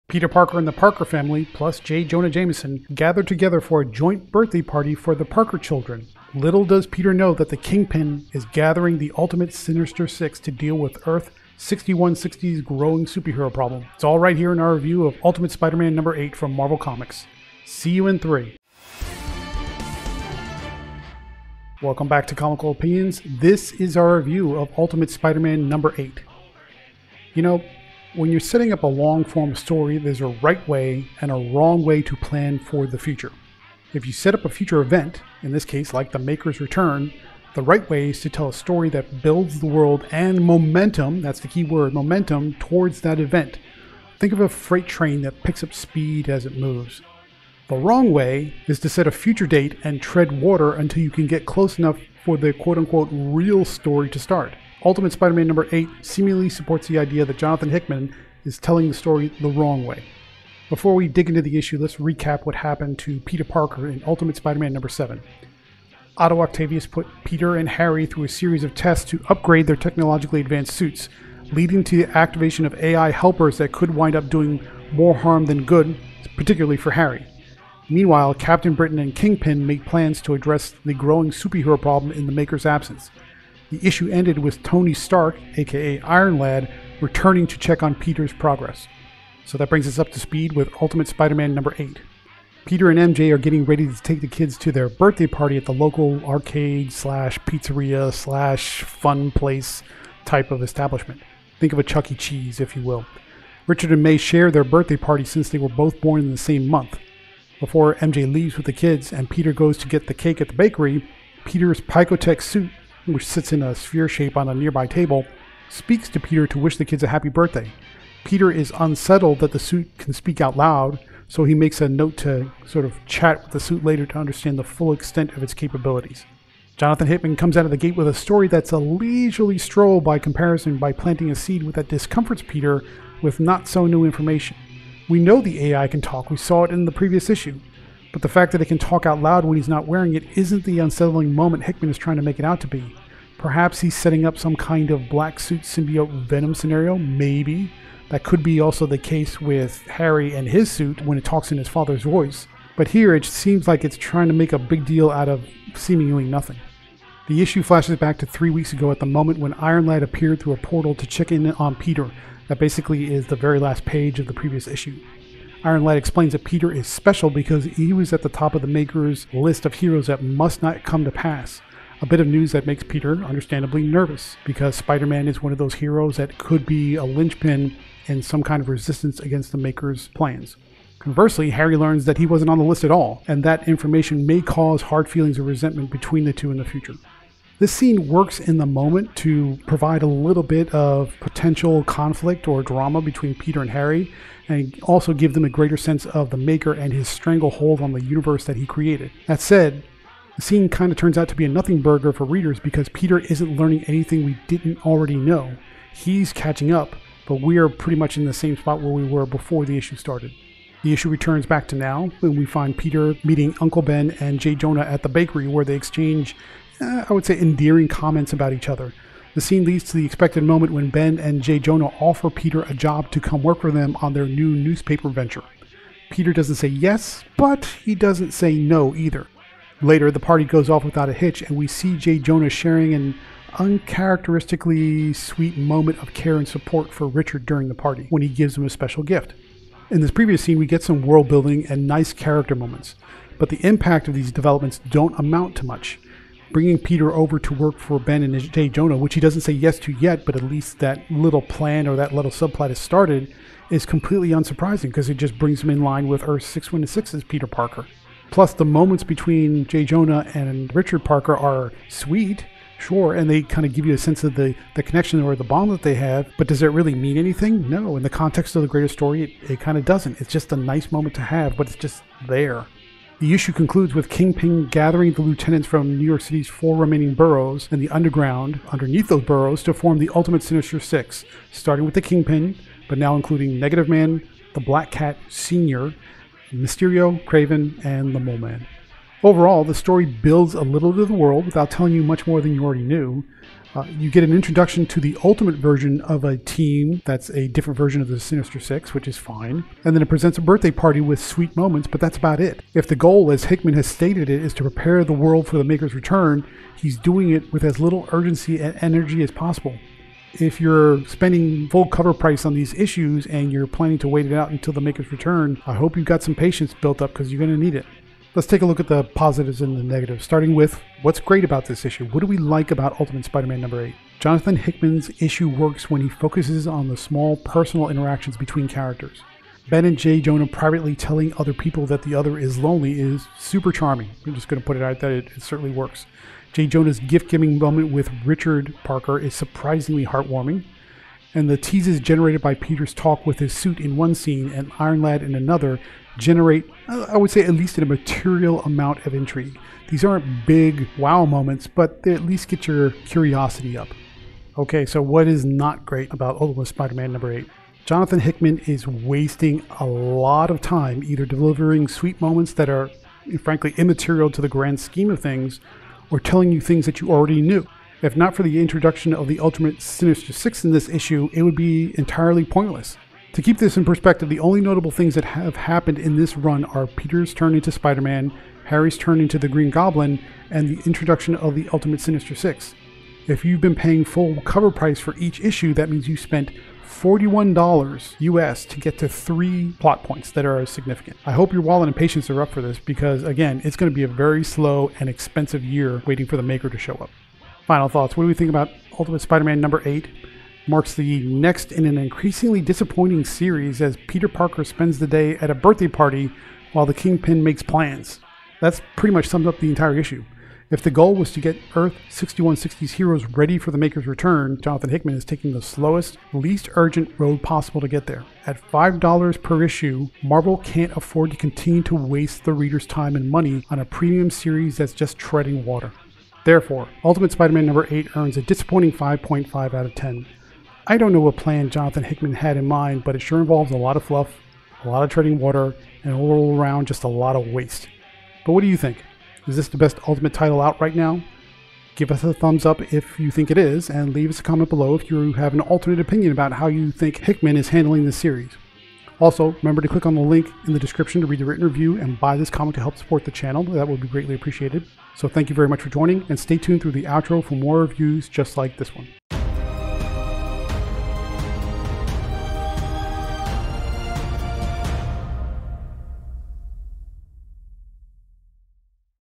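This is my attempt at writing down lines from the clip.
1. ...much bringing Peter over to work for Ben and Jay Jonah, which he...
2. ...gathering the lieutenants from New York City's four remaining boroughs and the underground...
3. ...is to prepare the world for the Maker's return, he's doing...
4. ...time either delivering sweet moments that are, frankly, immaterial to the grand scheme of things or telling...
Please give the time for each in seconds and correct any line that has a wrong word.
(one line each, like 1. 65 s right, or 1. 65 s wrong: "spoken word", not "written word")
1. 245 s right
2. 274 s right
3. 304 s right
4. 360 s right.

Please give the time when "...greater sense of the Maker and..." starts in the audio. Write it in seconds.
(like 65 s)
195 s.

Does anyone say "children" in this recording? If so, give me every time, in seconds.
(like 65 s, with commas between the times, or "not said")
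5 s.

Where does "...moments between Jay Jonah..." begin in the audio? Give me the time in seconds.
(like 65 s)
258 s.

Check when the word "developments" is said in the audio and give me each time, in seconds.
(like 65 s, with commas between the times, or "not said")
244 s.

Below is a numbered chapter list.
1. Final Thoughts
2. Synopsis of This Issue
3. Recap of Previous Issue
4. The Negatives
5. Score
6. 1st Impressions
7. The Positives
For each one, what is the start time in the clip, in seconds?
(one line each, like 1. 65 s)
1. 397 s
2. 89 s
3. 60 s
4. 354 s
5. 428 s
6. 21 s
7. 318 s.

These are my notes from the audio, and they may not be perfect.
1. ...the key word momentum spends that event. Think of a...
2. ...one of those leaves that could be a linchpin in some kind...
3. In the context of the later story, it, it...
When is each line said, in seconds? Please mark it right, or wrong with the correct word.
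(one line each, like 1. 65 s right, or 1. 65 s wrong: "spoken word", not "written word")
1. 41 s wrong: "towards", not "spends"
2. 175 s wrong: "heroes", not "leaves"
3. 267 s wrong: "greater", not "later".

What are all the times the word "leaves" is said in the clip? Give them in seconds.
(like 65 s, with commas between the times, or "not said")
108 s, 444 s.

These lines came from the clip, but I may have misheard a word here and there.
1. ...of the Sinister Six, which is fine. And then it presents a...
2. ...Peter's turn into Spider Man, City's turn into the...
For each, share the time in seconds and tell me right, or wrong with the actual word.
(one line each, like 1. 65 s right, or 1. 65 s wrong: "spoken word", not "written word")
1. 298 s right
2. 376 s wrong: "Harry", not "City".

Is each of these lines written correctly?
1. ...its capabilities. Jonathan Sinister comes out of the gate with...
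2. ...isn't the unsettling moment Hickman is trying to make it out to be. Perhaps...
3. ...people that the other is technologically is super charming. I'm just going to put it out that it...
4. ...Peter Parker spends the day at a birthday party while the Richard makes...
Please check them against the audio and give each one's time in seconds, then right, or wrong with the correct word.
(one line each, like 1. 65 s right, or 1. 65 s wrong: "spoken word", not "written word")
1. 125 s wrong: "Hickman", not "Sinister"
2. 140 s right
3. 331 s wrong: "lonely", not "technologically"
4. 404 s wrong: "Kingpin", not "Richard".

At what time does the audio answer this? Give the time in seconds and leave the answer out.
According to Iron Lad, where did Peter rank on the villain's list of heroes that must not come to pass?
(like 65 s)
168 s.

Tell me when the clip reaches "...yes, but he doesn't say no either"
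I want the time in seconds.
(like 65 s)
226 s.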